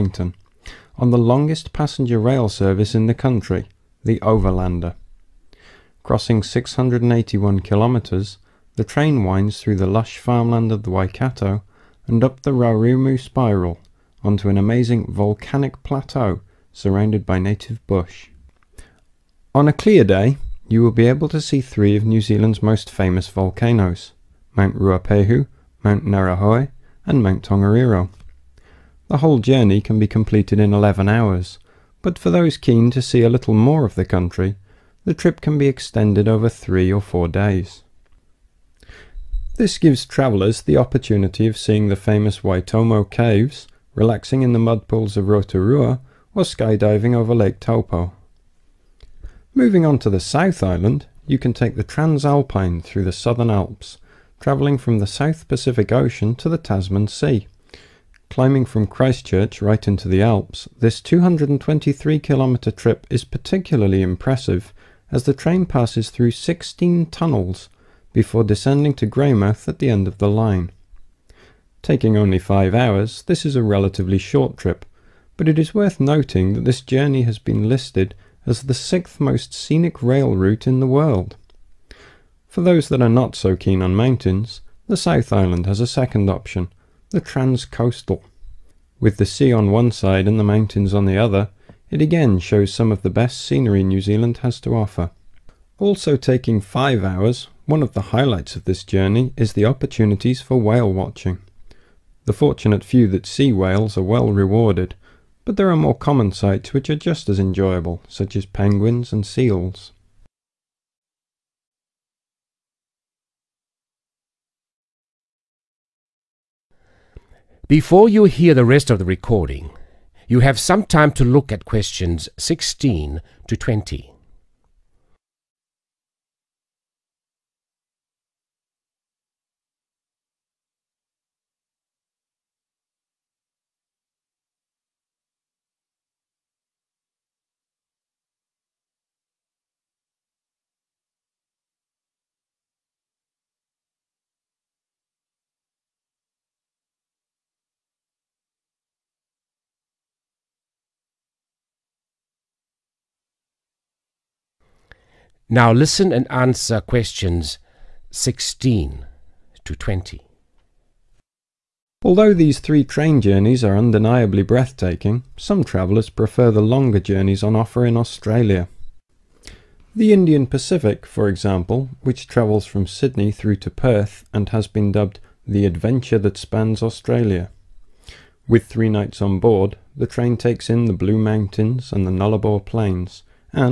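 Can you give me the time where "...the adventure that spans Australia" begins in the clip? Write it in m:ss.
2:55.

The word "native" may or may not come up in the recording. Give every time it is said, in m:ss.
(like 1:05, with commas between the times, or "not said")
0:17.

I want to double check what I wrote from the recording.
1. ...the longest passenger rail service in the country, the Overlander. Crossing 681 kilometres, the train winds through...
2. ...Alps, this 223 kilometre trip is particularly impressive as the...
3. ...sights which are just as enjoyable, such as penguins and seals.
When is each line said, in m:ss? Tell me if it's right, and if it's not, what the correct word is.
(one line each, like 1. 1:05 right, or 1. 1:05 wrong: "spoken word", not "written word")
1. 0:01 right
2. 1:00 right
3. 1:46 right.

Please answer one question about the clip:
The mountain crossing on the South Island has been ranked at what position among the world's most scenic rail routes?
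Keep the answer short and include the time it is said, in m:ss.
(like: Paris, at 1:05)
sixth, at 1:18.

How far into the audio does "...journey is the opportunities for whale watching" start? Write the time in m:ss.
1:38.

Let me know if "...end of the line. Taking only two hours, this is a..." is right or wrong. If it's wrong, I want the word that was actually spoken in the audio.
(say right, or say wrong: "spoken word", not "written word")
wrong: "five", not "two".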